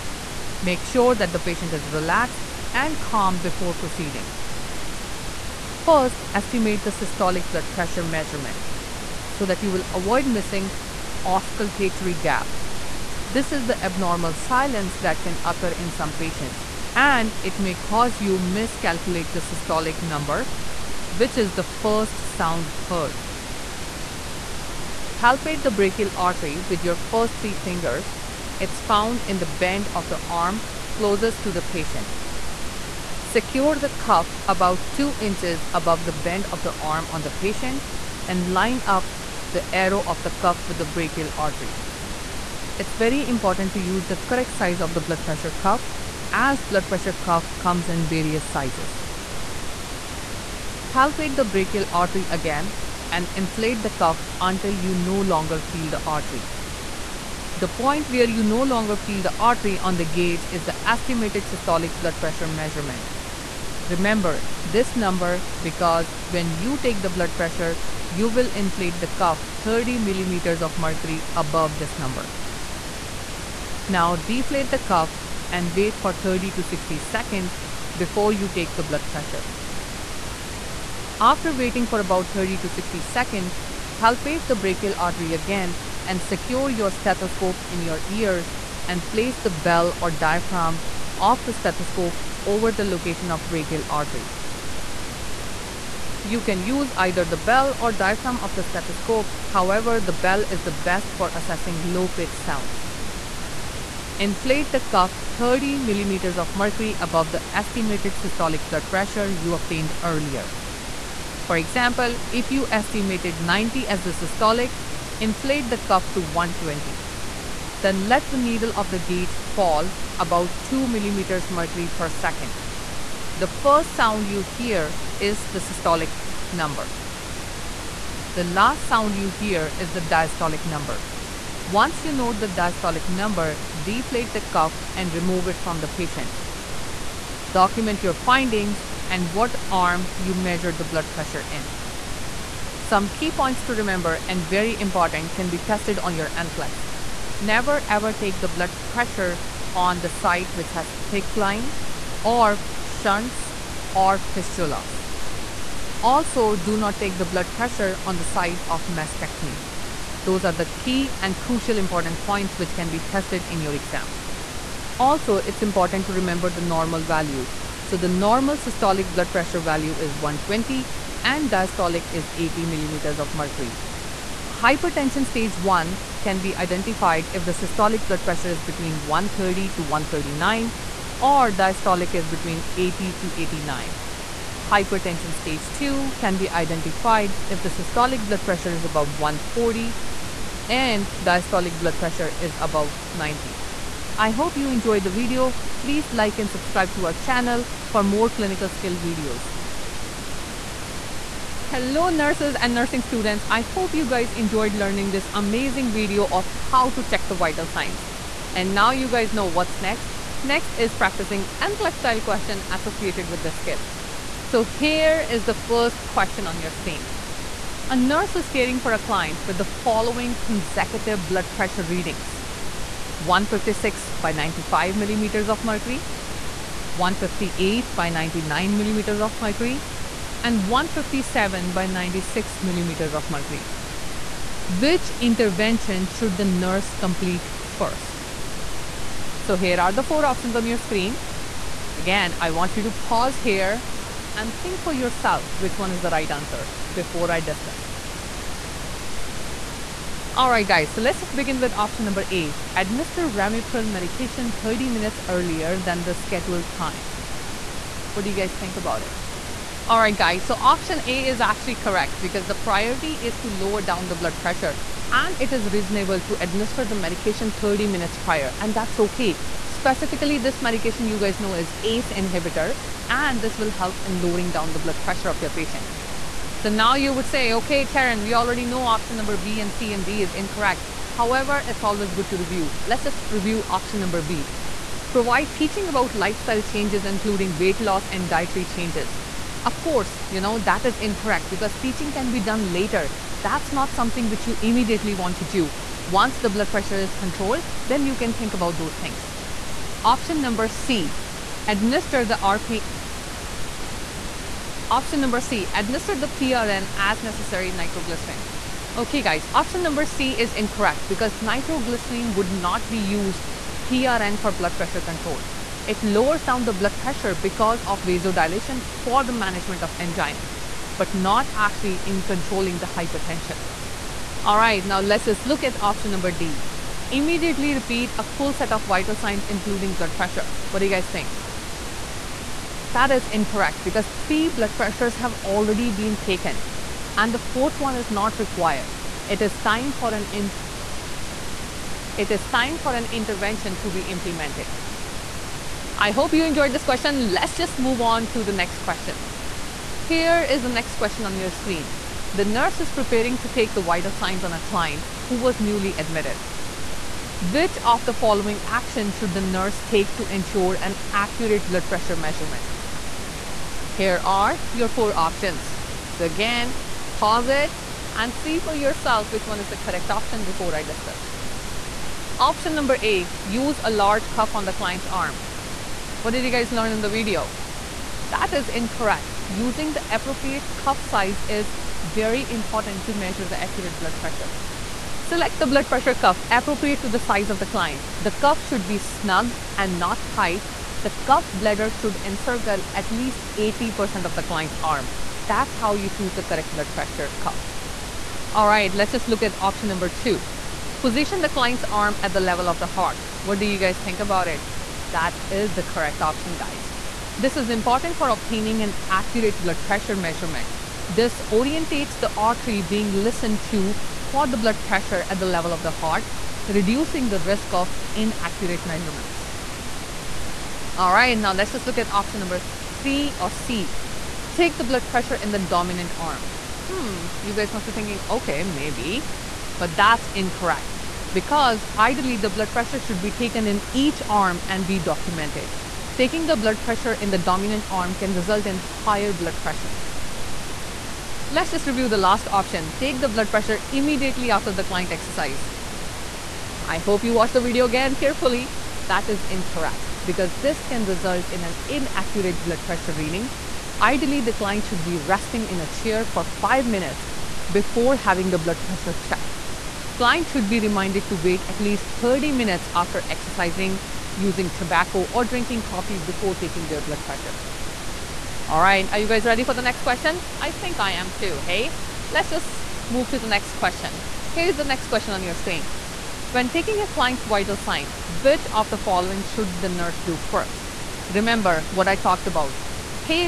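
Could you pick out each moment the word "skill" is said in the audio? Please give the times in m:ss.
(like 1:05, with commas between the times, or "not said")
3:18, 3:33.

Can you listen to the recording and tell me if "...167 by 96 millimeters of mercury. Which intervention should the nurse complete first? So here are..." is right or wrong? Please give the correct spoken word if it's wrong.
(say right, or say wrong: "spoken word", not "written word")
wrong: "157", not "167".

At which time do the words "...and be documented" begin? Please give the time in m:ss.
7:14.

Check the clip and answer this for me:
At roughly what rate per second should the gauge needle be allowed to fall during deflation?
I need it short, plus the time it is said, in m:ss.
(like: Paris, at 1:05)
2 millimeters mercury, at 2:00.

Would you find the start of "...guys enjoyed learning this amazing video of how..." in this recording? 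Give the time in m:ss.
3:24.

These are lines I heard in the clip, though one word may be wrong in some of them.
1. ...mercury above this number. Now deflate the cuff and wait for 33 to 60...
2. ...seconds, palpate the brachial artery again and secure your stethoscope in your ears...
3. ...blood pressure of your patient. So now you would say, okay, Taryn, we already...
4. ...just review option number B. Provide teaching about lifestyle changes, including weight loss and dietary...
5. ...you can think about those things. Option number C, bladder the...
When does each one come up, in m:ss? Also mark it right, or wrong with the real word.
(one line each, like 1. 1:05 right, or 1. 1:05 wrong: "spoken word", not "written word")
1. 1:10 wrong: "30", not "33"
2. 1:23 right
3. 4:34 right
4. 4:43 right
5. 4:58 wrong: "administer", not "bladder".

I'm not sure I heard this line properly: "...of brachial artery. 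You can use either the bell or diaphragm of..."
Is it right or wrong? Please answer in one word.
right.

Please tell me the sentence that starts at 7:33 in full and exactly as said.
Ideally, the client should be resting in a chair for five minutes before having the blood pressure checked.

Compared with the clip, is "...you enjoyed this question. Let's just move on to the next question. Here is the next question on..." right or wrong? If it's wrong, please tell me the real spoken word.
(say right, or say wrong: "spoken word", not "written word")
right.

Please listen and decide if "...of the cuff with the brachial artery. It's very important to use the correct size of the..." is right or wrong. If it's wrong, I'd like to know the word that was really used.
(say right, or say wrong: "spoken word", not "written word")
right.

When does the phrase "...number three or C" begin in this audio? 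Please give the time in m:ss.
7:02.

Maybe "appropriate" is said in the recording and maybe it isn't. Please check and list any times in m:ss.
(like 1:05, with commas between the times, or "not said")
6:20, 6:26.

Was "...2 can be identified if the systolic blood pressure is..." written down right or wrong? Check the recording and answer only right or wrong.
right.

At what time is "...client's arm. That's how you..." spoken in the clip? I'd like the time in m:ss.
6:34.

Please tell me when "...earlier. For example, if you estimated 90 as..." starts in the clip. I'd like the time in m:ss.
1:50.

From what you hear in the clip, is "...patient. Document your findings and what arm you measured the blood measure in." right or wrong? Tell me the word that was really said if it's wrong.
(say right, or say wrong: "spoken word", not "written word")
wrong: "pressure", not "measure".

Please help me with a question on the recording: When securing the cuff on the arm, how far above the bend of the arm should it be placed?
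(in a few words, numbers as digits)
2 inches.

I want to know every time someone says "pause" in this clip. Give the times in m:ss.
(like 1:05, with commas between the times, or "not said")
4:02, 6:07.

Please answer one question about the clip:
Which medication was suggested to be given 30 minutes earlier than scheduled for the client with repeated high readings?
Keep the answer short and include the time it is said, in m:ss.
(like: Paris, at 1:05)
Ramipril, at 4:13.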